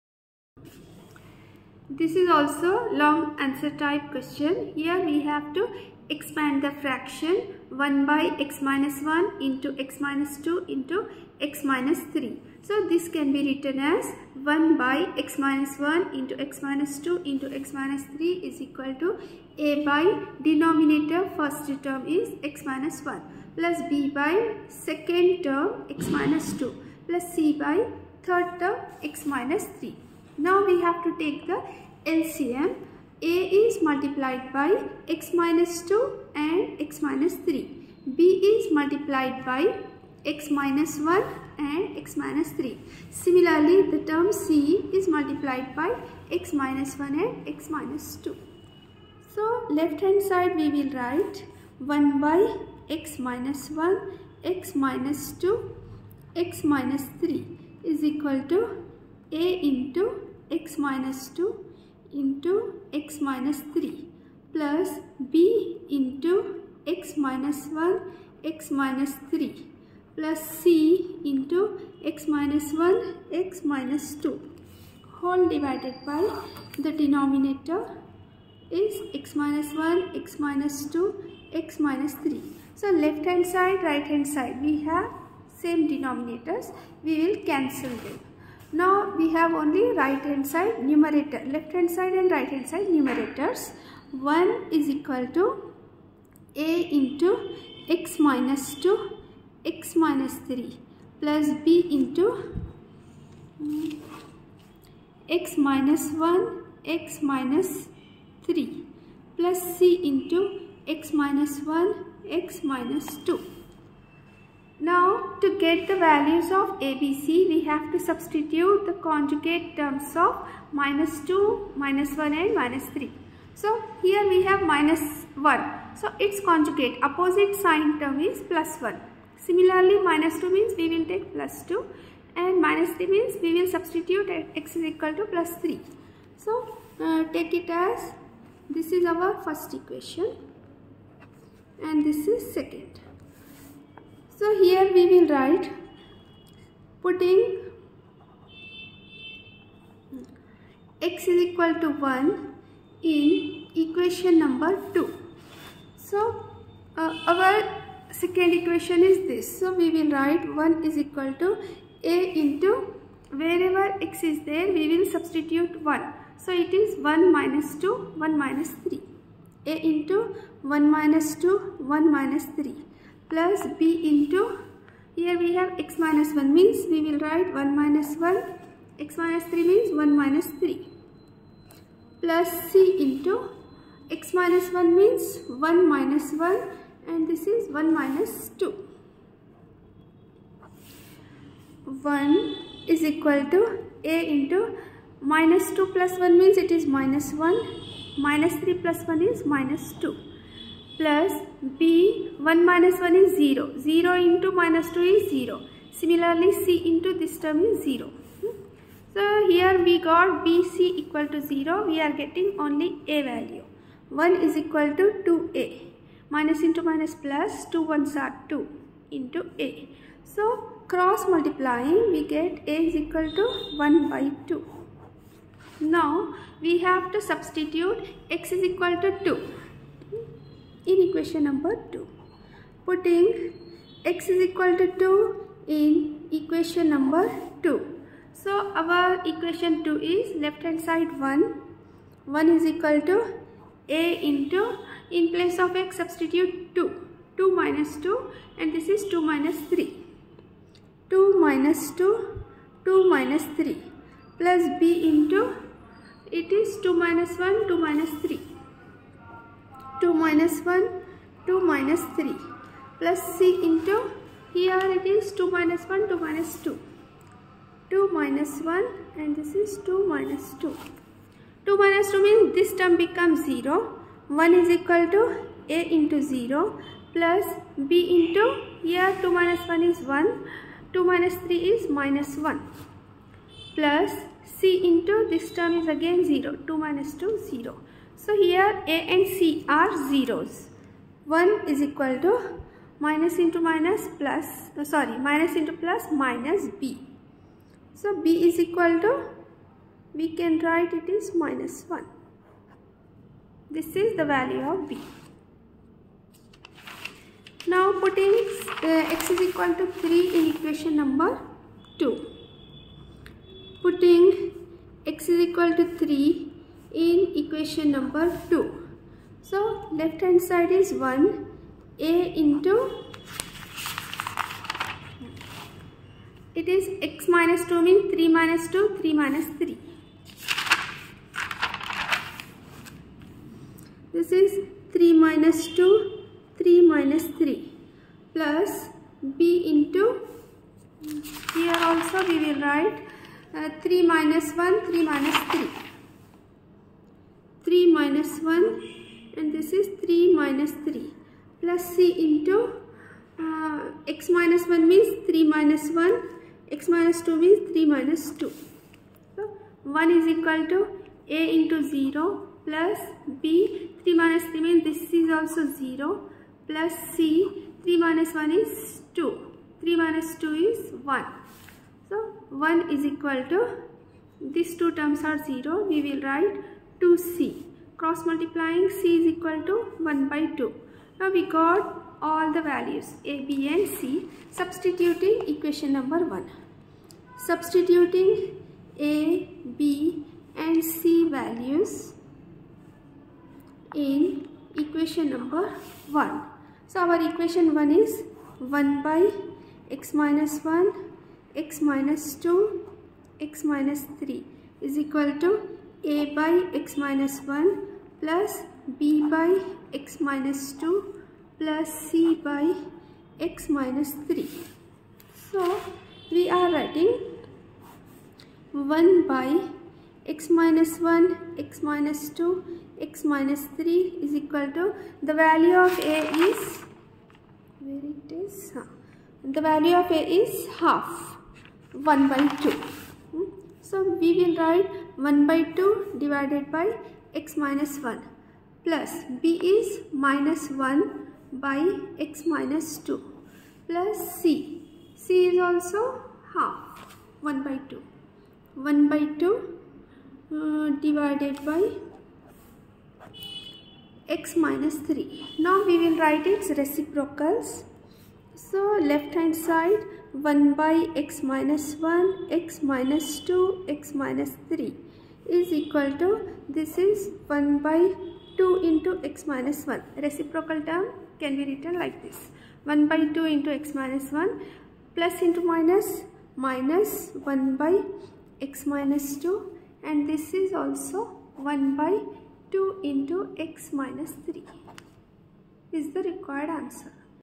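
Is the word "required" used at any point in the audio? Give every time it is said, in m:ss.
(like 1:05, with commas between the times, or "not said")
8:06.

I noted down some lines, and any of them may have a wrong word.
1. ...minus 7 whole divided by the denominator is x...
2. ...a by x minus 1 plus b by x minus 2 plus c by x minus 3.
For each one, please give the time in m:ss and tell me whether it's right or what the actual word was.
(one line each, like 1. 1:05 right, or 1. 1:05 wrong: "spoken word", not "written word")
1. 1:13 wrong: "2", not "7"
2. 6:46 right.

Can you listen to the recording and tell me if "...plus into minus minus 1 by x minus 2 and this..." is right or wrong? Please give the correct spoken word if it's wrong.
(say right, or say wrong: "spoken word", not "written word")
right.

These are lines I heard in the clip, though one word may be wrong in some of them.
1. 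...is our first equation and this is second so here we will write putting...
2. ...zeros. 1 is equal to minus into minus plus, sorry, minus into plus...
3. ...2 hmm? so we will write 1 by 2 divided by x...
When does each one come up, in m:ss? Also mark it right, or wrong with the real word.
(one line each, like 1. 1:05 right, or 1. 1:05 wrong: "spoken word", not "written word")
1. 2:18 right
2. 4:50 right
3. 7:12 right.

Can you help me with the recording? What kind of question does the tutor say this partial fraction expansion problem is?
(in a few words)
long answer type.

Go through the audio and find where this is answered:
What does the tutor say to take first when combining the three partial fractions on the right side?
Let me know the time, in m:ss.
0:32.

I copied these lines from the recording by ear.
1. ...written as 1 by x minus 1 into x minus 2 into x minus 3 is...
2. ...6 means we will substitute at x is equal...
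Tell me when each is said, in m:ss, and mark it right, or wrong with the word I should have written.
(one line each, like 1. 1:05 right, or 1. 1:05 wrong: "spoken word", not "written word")
1. 0:13 right
2. 2:12 wrong: "3", not "6".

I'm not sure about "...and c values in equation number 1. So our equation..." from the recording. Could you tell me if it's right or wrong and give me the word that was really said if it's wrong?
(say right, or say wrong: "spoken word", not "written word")
right.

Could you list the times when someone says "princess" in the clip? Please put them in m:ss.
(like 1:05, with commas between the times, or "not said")
not said.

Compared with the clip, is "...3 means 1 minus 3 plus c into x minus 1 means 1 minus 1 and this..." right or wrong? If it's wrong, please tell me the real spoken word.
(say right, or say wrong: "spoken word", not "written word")
right.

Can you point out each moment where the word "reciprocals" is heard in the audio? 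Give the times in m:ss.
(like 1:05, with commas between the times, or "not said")
7:36, 7:50.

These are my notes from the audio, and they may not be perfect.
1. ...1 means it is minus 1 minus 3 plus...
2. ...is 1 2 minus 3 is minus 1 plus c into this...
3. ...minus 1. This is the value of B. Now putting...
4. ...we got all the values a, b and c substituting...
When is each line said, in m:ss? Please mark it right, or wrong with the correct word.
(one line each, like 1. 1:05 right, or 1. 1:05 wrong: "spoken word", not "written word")
1. 3:16 right
2. 4:39 right
3. 5:01 right
4. 6:21 right.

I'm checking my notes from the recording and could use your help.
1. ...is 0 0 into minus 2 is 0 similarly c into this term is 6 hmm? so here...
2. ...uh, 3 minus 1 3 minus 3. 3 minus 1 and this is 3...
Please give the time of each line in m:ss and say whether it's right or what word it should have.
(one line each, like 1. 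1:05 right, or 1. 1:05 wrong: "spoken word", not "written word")
1. 3:23 wrong: "0", not "6"
2. 5:43 right.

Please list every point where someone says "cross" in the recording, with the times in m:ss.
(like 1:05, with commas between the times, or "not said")
3:40, 6:17.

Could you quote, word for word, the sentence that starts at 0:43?
Similarly, the term C is multiplied by x minus 1 and x minus 2.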